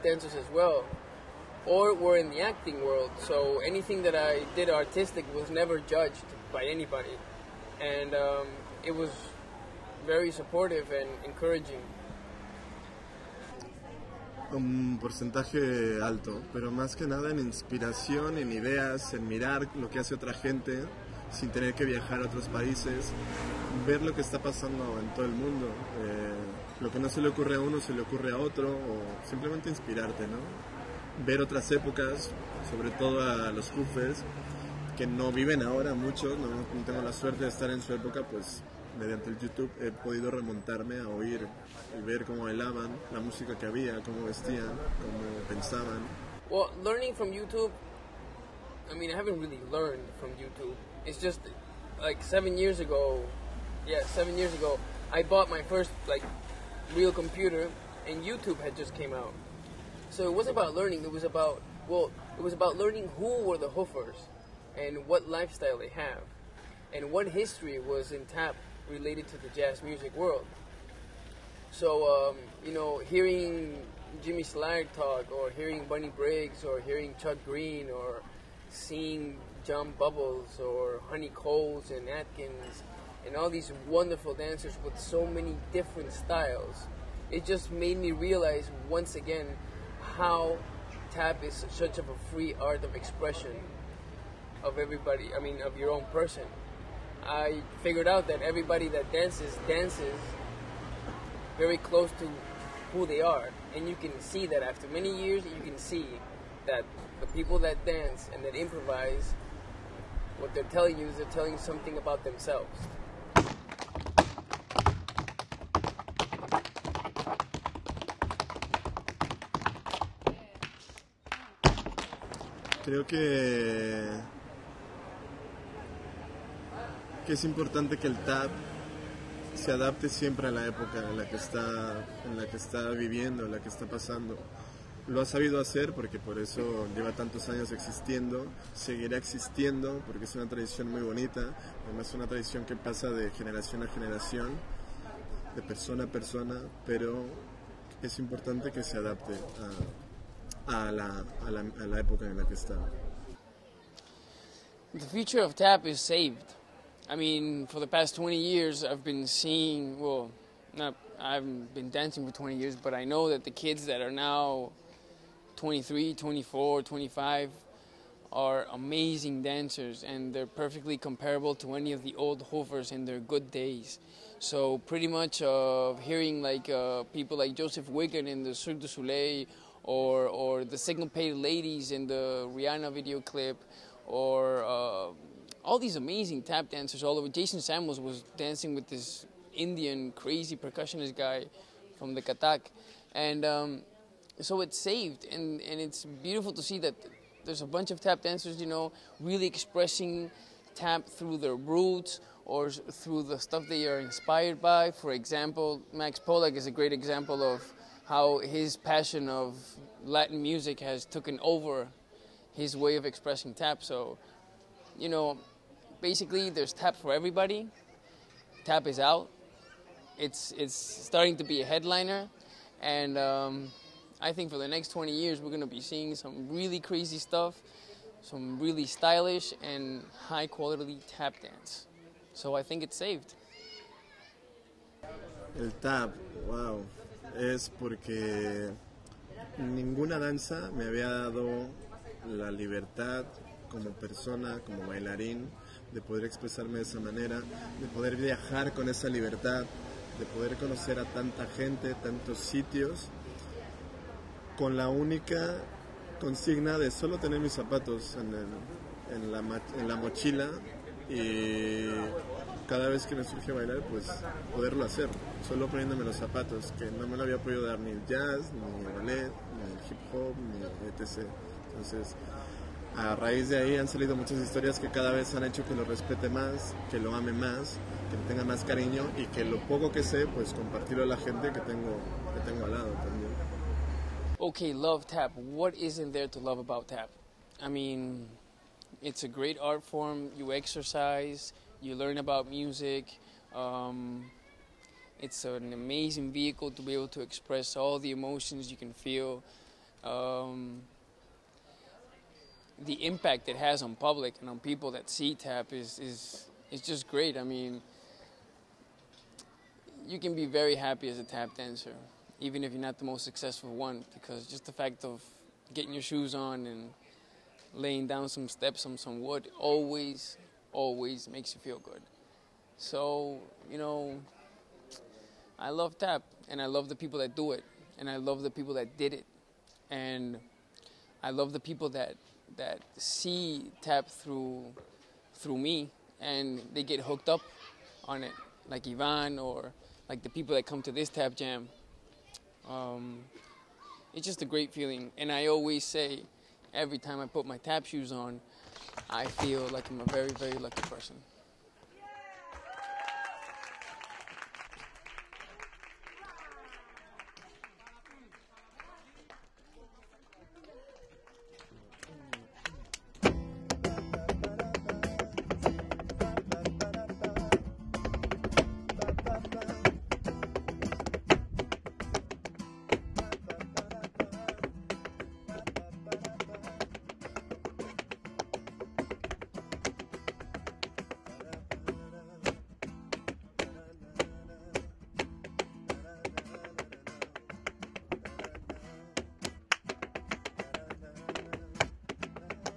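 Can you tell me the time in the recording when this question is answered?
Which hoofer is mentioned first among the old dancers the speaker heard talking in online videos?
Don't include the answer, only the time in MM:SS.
01:14.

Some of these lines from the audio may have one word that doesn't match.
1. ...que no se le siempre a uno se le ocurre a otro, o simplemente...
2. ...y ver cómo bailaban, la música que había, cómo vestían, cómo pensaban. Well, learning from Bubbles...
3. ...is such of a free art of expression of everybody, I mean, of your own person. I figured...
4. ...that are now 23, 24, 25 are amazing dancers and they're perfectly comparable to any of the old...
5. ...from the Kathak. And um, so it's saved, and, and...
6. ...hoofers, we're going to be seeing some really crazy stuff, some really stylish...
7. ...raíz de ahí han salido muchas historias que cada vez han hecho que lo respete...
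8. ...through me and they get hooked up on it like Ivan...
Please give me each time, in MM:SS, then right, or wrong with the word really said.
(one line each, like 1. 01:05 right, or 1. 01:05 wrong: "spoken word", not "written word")
1. 00:26 wrong: "ocurre", not "siempre"
2. 00:41 wrong: "YouTube", not "Bubbles"
3. 01:31 right
4. 02:43 right
5. 03:11 right
6. 03:45 wrong: "years", not "hoofers"
7. 04:33 right
8. 05:35 right.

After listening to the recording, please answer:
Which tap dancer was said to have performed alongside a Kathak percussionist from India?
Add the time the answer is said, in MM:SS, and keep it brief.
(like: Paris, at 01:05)
Jason Samuels, at 03:07.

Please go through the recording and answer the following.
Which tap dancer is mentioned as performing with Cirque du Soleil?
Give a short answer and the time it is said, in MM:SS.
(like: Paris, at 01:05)
Joseph Wiggan, at 02:57.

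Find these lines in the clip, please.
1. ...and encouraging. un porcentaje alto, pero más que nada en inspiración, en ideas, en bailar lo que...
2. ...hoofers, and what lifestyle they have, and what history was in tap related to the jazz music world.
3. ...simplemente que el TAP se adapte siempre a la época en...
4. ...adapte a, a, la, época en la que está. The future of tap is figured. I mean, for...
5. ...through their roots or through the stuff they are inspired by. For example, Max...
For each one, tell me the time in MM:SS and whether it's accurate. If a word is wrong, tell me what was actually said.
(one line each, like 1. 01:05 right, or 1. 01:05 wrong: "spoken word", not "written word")
1. 00:10 wrong: "mirar", not "bailar"
2. 01:03 right
3. 02:07 wrong: "importante", not "simplemente"
4. 02:28 wrong: "saved", not "figured"
5. 03:21 right.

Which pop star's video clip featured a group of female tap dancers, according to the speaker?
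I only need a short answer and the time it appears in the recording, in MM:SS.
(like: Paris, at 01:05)
Rihanna, at 03:02.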